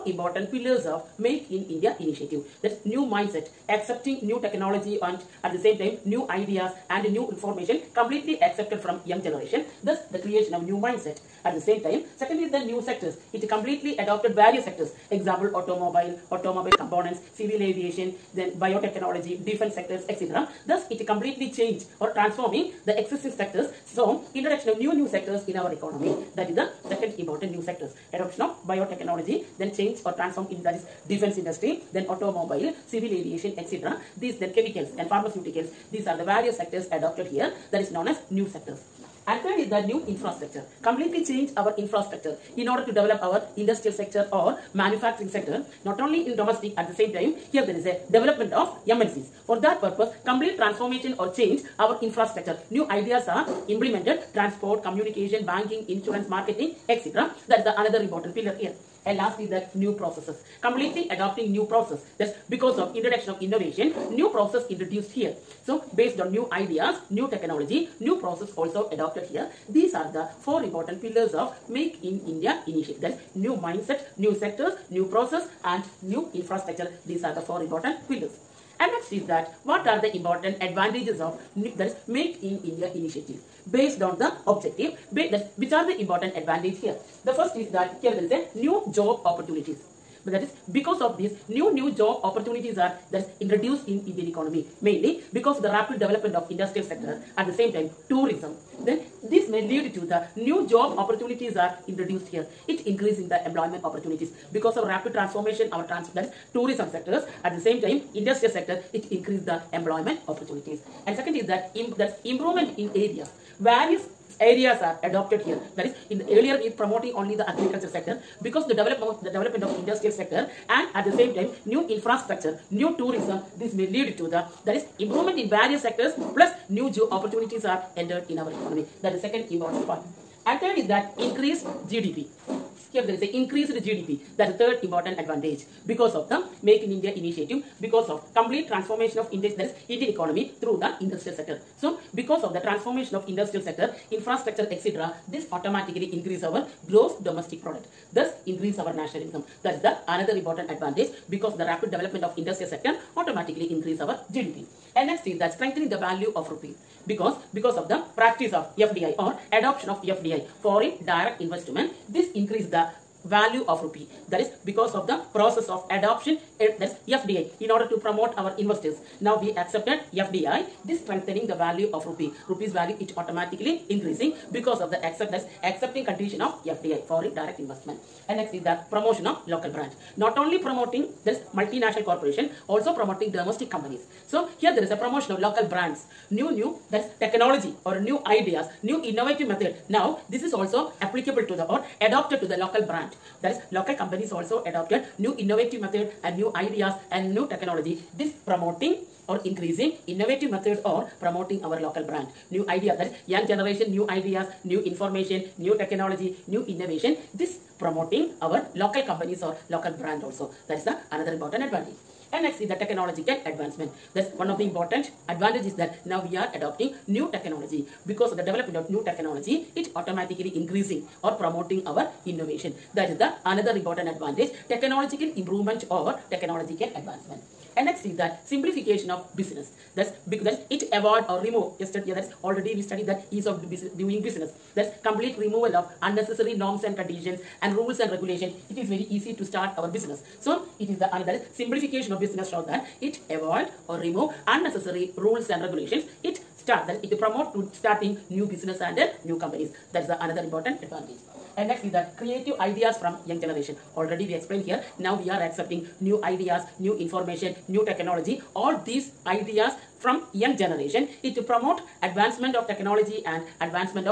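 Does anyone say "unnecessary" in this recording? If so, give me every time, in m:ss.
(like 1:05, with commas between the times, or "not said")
3:56, 4:04.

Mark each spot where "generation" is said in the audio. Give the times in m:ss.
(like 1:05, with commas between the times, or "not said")
0:09, 3:23, 4:13, 4:20.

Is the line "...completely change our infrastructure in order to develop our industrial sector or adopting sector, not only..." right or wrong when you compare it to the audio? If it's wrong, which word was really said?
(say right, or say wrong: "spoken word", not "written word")
wrong: "manufacturing", not "adopting".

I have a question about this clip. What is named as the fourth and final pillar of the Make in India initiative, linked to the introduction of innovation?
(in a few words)
New processes.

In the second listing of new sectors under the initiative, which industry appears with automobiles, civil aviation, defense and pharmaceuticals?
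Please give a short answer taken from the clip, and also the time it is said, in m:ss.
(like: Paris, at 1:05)
Chemicals, at 0:34.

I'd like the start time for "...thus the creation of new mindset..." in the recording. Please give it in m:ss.
0:09.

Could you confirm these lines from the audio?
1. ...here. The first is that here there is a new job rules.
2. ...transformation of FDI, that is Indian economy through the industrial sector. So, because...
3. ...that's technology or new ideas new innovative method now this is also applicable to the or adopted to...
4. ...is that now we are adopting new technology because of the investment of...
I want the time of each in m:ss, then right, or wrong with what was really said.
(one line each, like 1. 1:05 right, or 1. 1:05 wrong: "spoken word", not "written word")
1. 1:26 wrong: "opportunities", not "rules"
2. 2:18 wrong: "India", not "FDI"
3. 3:06 right
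4. 3:35 wrong: "development", not "investment".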